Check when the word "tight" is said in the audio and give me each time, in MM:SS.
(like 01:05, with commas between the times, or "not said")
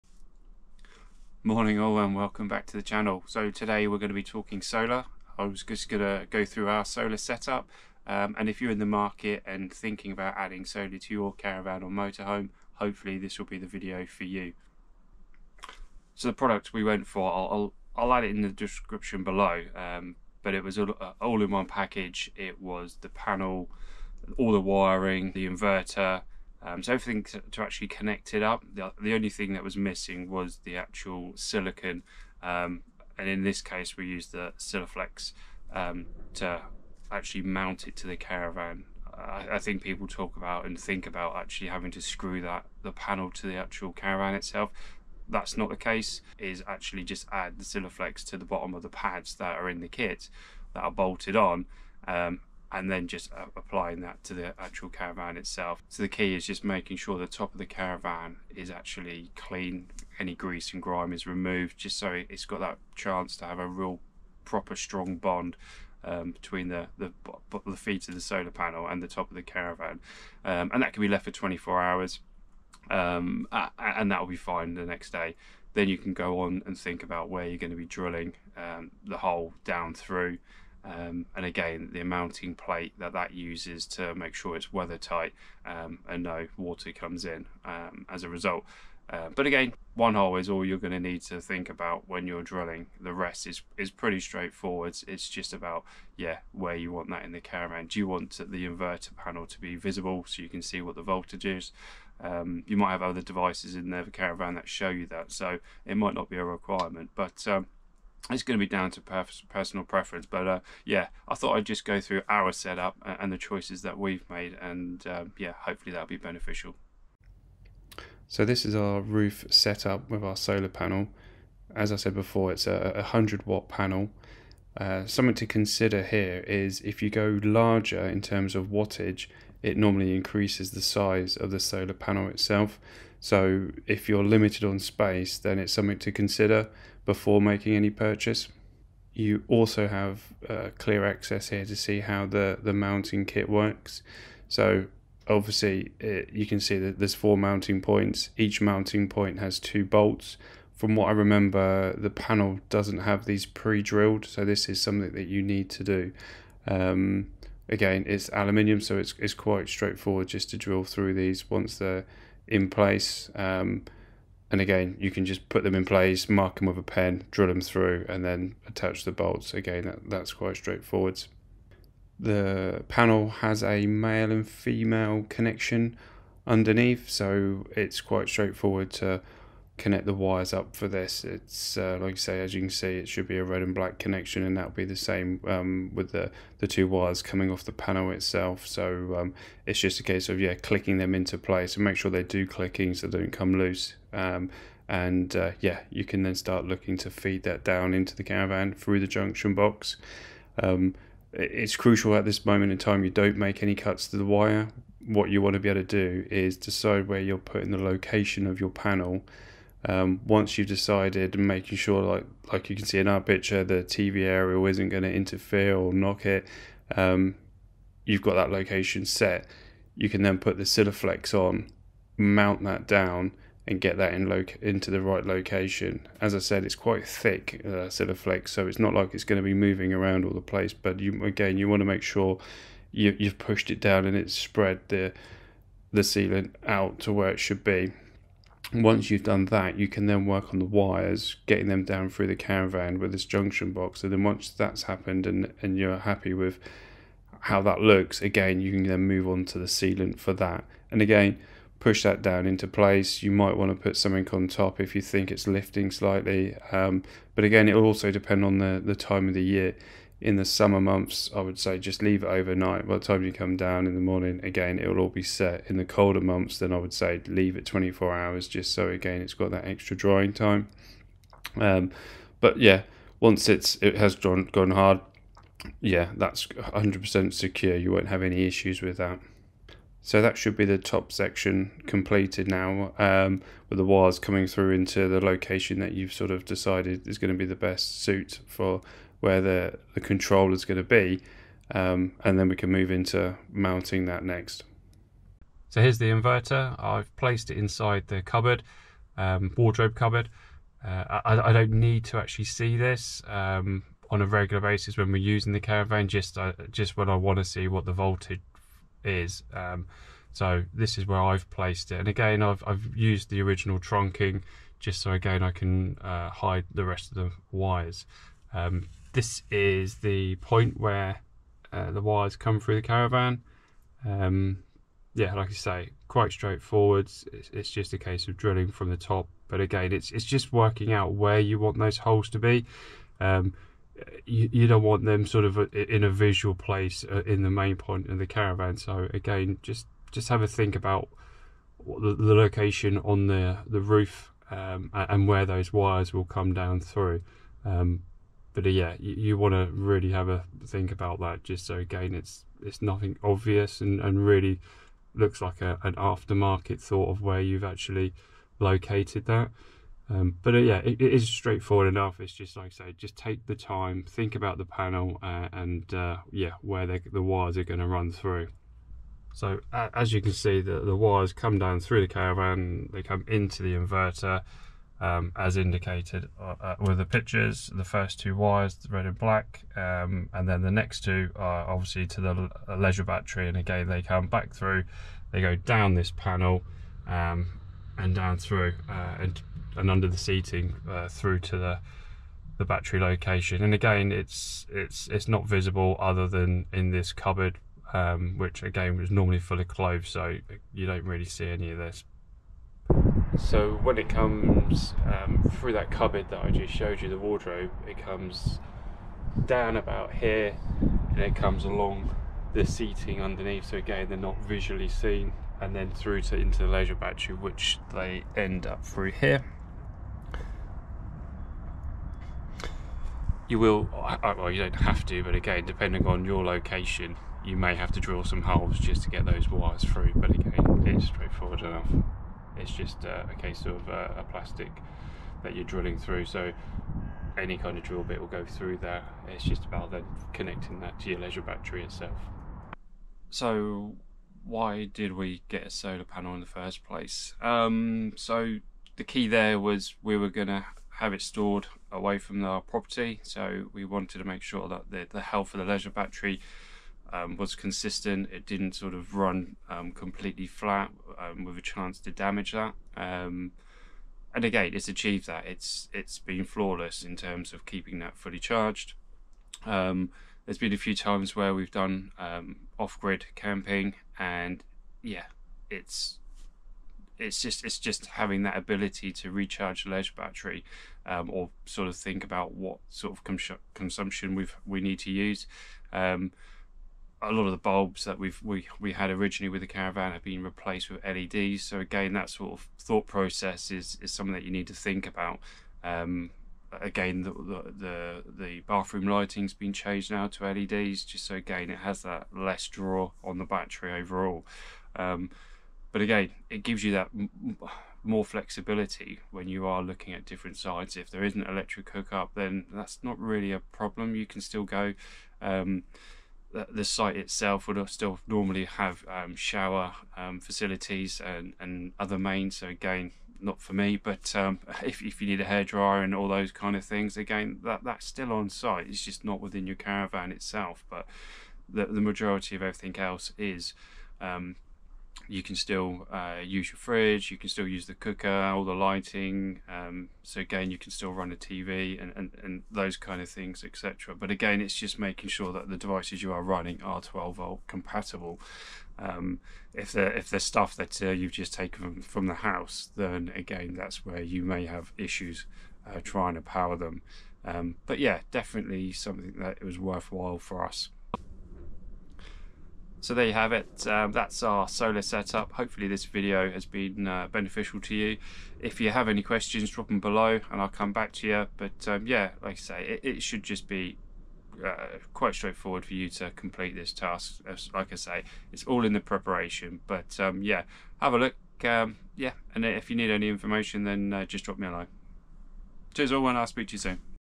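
01:24.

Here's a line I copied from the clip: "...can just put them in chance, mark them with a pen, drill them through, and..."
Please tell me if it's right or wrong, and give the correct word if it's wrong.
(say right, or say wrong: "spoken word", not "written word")
wrong: "place", not "chance".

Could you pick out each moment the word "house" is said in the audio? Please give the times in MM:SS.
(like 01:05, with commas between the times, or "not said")
09:12.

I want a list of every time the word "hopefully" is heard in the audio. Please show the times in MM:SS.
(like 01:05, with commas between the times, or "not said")
00:12, 01:55, 09:25.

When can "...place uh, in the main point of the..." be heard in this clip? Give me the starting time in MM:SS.
05:36.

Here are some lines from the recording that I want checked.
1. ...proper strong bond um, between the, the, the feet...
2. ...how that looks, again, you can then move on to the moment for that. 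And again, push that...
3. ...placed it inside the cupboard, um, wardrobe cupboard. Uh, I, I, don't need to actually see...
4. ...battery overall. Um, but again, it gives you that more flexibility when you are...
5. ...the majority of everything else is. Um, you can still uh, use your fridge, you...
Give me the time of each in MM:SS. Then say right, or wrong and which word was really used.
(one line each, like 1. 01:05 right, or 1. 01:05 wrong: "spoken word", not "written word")
1. 01:04 right
2. 04:07 wrong: "sealant", not "moment"
3. 04:57 right
4. 08:23 right
5. 08:51 right.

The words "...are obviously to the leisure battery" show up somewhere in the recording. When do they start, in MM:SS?
06:21.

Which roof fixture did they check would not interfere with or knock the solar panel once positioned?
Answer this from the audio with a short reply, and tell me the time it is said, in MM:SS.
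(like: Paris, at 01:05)
TV aerial, at 03:33.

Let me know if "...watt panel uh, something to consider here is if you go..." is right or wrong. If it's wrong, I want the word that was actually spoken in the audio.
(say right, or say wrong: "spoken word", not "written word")
right.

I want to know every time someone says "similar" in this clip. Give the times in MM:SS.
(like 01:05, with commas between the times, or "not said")
not said.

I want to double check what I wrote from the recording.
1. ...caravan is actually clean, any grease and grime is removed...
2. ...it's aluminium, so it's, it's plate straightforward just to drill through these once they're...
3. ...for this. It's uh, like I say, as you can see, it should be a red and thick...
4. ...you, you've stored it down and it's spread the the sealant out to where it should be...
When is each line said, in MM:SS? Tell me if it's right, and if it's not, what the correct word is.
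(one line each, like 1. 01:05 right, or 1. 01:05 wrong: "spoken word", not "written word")
1. 00:57 right
2. 02:38 wrong: "quite", not "plate"
3. 03:00 wrong: "black", not "thick"
4. 03:52 wrong: "pushed", not "stored".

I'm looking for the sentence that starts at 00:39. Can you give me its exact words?
I, I, think people talk about and think about actually having to screw that the panel to the actual caravan itself.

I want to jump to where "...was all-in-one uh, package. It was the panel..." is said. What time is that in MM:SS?
00:20.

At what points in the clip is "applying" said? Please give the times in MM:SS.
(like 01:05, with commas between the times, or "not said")
00:53.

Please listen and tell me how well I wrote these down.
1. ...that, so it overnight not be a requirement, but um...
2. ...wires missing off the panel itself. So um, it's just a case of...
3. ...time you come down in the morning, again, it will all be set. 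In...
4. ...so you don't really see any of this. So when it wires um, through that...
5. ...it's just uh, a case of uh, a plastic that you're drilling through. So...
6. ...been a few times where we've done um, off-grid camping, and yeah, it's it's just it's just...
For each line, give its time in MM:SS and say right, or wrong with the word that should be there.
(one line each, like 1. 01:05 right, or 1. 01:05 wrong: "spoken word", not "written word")
1. 01:45 wrong: "might", not "overnight"
2. 03:06 wrong: "coming", not "missing"
3. 04:23 right
4. 06:40 wrong: "comes", not "wires"
5. 07:12 right
6. 07:50 right.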